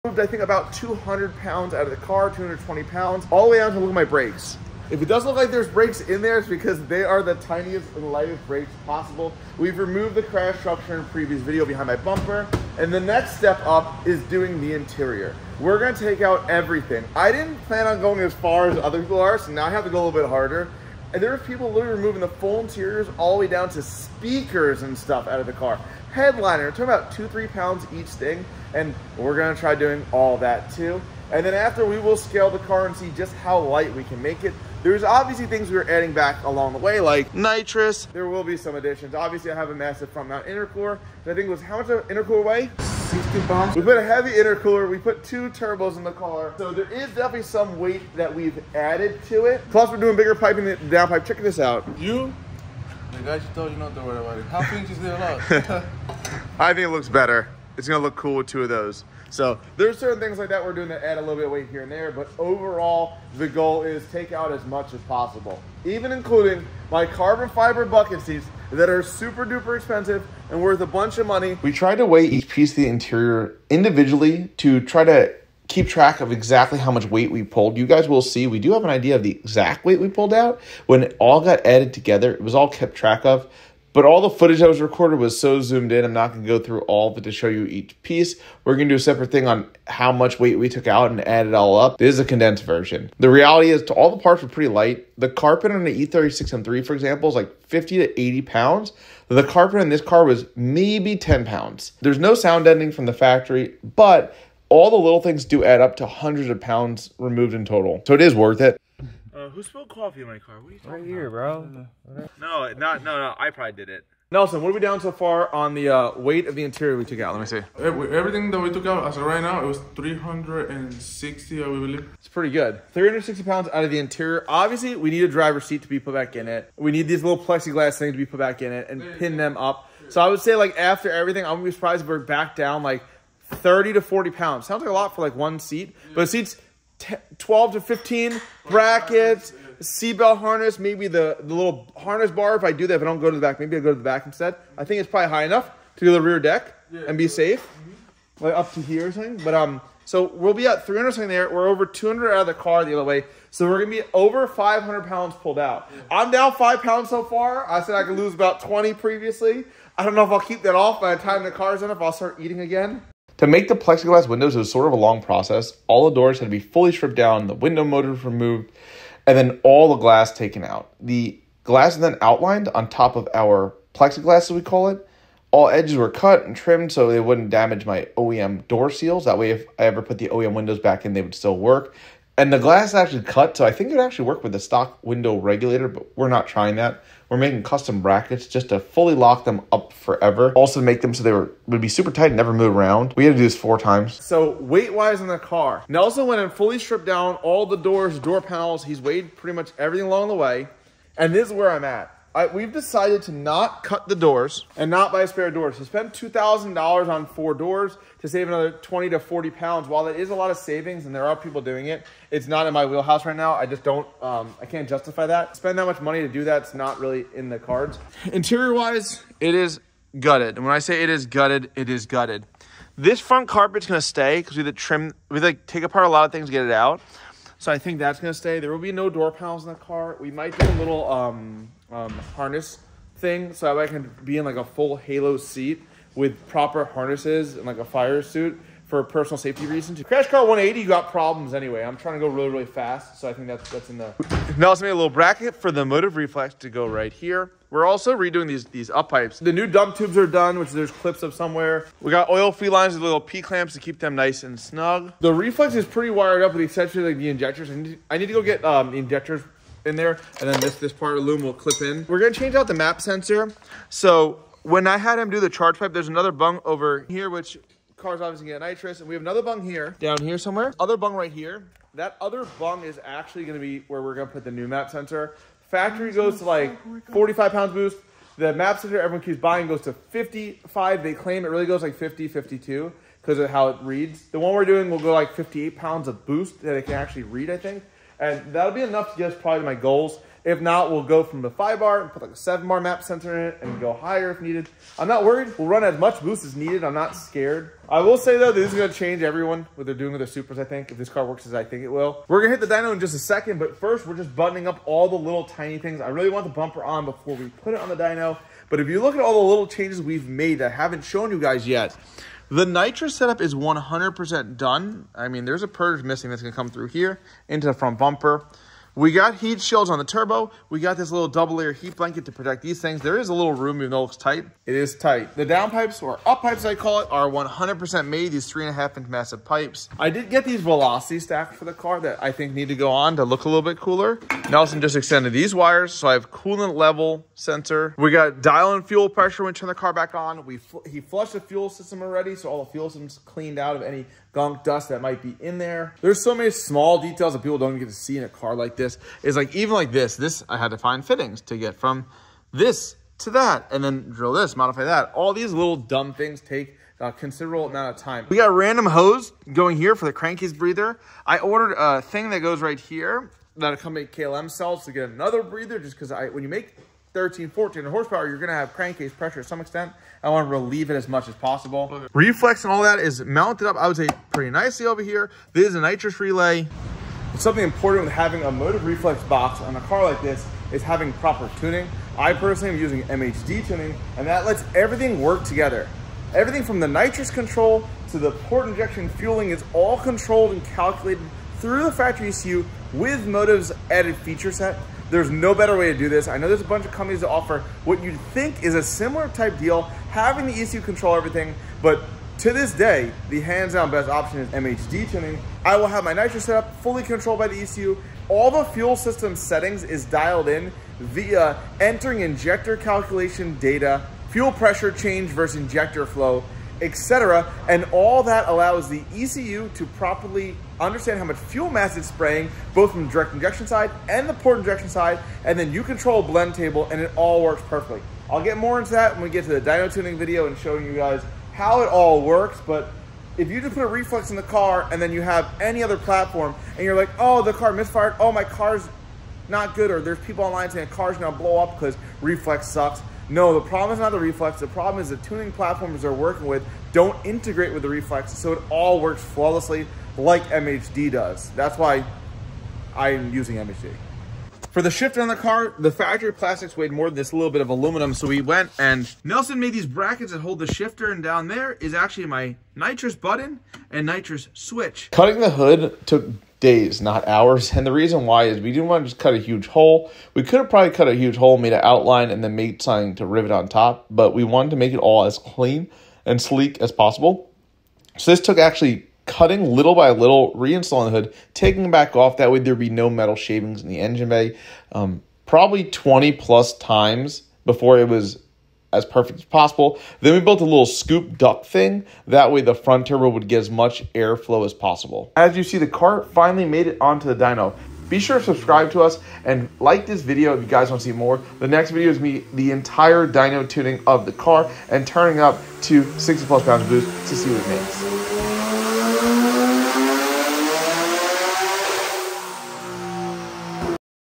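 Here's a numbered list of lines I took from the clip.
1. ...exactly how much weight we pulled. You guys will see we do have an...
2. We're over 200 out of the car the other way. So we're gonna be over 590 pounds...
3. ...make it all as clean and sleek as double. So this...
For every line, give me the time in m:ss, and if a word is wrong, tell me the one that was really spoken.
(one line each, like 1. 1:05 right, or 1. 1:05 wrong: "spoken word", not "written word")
1. 1:16 right
2. 2:31 wrong: "500", not "590"
3. 7:54 wrong: "possible", not "double".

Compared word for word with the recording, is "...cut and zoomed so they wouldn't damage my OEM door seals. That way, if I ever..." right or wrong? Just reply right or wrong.
wrong.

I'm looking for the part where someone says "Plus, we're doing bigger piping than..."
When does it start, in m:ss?
0:49.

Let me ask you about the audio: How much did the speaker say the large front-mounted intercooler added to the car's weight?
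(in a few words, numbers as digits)
60 pounds.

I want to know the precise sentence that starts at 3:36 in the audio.
It's not really in the cards.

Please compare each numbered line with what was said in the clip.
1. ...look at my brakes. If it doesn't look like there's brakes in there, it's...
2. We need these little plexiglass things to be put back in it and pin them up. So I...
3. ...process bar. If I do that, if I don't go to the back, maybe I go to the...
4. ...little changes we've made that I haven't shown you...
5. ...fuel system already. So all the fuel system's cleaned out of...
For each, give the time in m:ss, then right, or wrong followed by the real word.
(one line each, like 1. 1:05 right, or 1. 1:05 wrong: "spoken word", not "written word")
1. 0:03 right
2. 2:06 right
3. 2:21 wrong: "harness", not "process"
4. 5:09 right
5. 5:41 right.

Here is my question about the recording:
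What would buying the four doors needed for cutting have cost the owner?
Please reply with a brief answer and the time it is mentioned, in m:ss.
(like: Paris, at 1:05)
$2,000, at 3:26.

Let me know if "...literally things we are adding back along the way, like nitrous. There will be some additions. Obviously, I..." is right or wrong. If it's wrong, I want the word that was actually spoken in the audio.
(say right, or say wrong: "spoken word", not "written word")
wrong: "obviously", not "literally".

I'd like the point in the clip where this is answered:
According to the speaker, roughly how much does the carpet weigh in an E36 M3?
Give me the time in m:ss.
1:37.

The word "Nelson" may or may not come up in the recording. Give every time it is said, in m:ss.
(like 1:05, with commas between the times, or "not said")
1:54, 3:15, 5:34, 7:39.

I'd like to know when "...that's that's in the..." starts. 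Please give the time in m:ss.
4:03.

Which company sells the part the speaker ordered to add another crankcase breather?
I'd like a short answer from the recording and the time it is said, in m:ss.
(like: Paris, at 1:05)
KLM, at 6:04.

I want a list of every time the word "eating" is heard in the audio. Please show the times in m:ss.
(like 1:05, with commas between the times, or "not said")
2:42.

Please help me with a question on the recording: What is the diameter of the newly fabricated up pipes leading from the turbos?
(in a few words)
3.5 inches.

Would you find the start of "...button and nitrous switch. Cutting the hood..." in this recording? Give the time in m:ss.
7:43.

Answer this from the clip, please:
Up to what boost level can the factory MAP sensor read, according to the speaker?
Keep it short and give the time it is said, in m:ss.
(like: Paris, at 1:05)
45 pounds, at 4:37.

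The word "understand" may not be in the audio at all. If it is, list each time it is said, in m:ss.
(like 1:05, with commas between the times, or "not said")
7:00.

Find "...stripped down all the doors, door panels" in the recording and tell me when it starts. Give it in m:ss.
3:16.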